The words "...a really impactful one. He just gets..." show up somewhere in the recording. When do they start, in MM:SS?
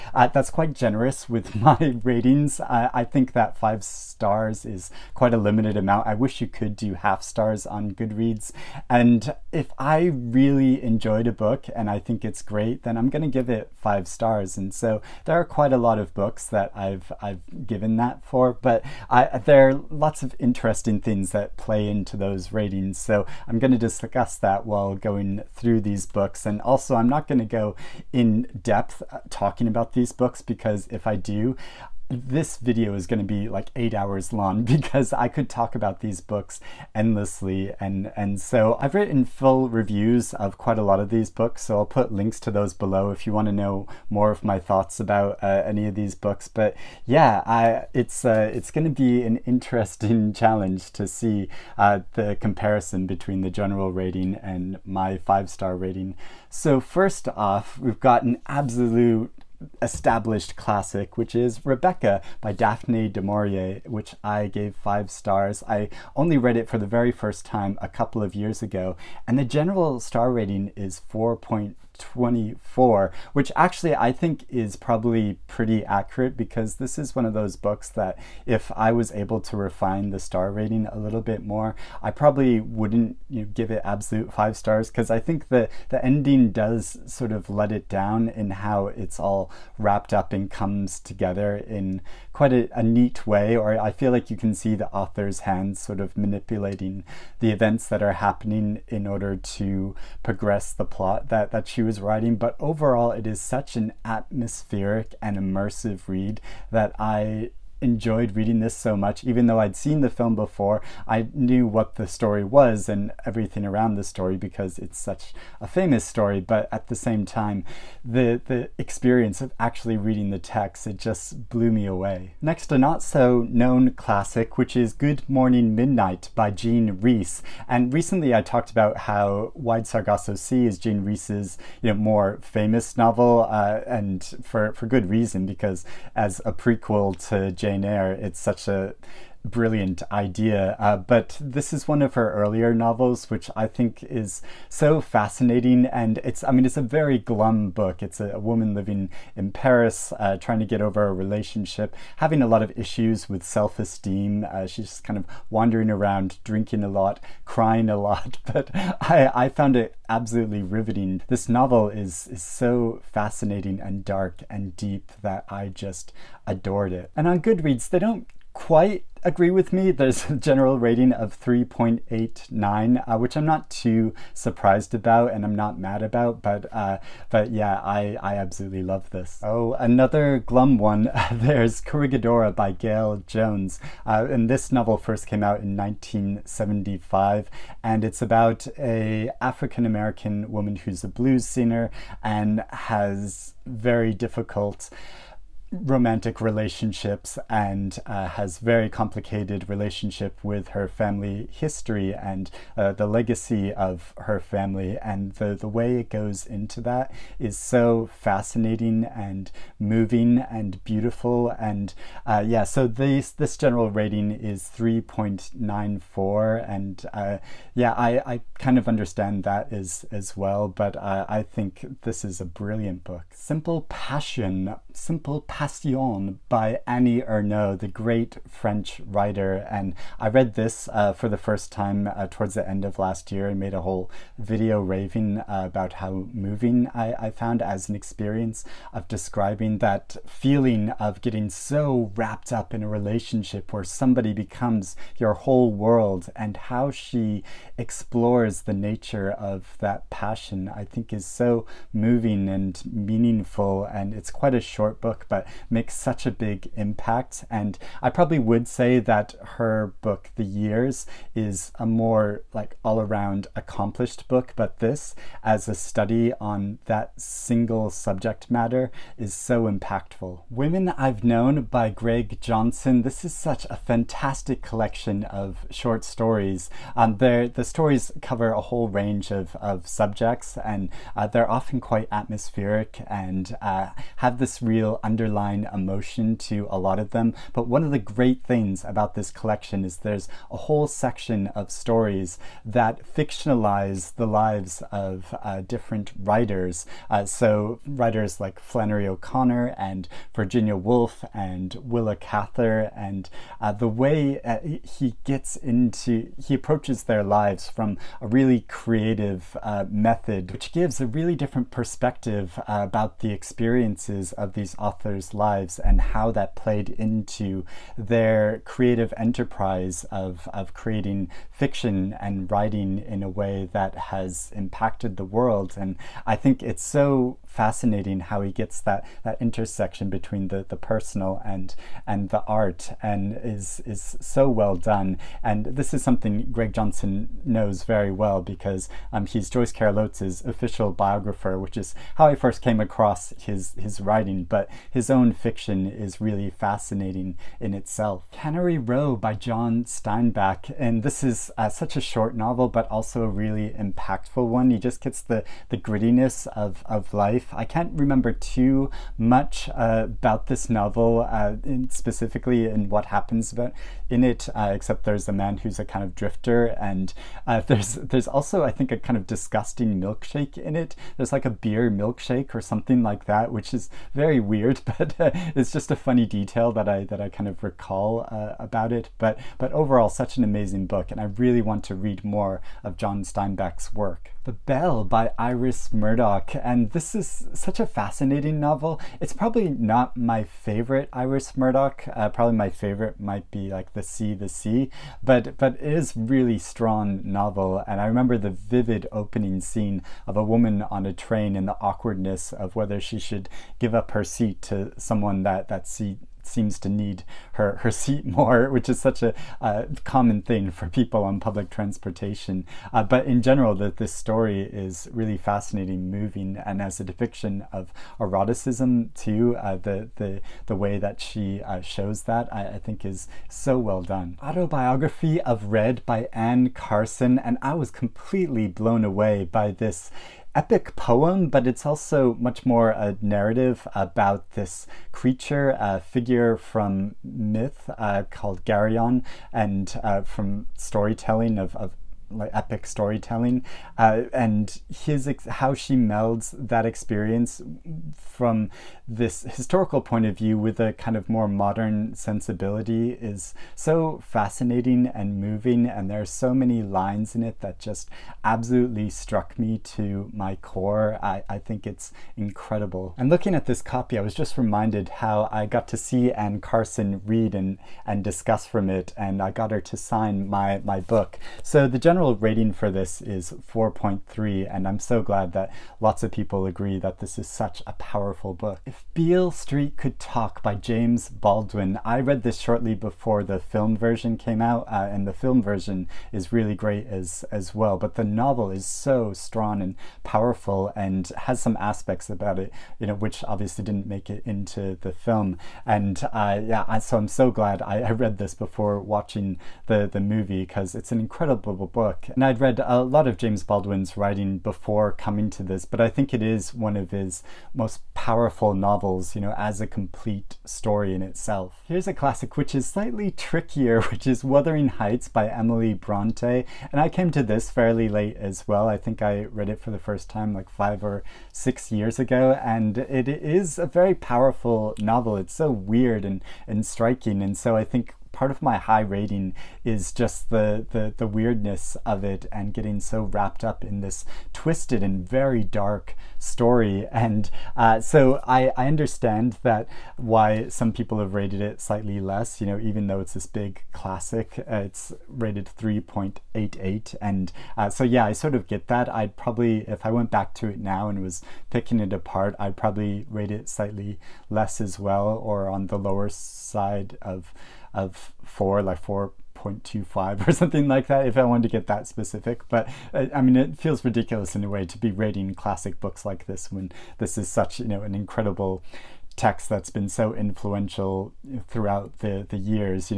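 05:53.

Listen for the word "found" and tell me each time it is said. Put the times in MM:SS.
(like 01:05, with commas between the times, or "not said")
02:39, 03:57.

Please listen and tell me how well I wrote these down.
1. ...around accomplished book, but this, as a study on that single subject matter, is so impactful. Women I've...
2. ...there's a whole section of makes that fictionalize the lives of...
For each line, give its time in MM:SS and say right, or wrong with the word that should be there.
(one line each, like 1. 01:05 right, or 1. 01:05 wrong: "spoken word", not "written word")
1. 04:22 right
2. 04:49 wrong: "stories", not "makes".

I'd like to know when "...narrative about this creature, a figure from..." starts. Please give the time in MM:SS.
07:13.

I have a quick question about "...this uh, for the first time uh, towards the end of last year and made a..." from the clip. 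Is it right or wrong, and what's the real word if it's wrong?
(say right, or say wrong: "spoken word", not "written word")
right.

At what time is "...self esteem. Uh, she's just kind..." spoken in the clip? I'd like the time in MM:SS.
02:33.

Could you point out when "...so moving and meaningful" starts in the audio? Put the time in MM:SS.
04:11.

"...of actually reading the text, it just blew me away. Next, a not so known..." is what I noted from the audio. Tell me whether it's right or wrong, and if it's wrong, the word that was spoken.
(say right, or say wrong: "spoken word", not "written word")
right.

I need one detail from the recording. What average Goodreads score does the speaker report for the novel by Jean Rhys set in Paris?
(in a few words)
3.89.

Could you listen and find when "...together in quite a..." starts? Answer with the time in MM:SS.
01:30.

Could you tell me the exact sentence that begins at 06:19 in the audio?
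But but overall, such an amazing book, and I really want to read more of John Steinbeck's work.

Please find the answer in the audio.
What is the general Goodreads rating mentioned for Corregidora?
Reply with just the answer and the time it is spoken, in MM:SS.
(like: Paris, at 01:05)
3.94, at 03:34.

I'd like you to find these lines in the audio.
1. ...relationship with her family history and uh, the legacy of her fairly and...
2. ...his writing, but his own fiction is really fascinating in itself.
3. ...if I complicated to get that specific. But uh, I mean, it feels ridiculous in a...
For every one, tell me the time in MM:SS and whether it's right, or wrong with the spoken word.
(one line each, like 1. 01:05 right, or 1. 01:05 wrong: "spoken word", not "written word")
1. 03:19 wrong: "family", not "fairly"
2. 05:43 right
3. 09:21 wrong: "wanted", not "complicated".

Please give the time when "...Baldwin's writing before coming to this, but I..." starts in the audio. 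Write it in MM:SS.
08:23.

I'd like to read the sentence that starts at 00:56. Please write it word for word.
So, first off, we've got an absolute established classic, which is Rebecca by Daphne du Maurier, which I gave five stars.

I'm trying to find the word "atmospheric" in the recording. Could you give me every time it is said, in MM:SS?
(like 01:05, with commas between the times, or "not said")
01:44, 04:42.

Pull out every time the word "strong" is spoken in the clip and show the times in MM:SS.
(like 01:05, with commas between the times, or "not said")
06:36, 08:09.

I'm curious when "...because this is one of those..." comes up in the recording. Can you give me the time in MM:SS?
01:16.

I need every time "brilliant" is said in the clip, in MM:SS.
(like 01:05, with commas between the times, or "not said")
02:19, 03:42.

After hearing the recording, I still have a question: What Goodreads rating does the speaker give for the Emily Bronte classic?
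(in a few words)
3.88.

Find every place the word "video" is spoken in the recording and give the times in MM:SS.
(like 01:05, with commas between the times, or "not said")
00:32, 03:54.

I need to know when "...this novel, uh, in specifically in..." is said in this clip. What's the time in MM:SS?
06:00.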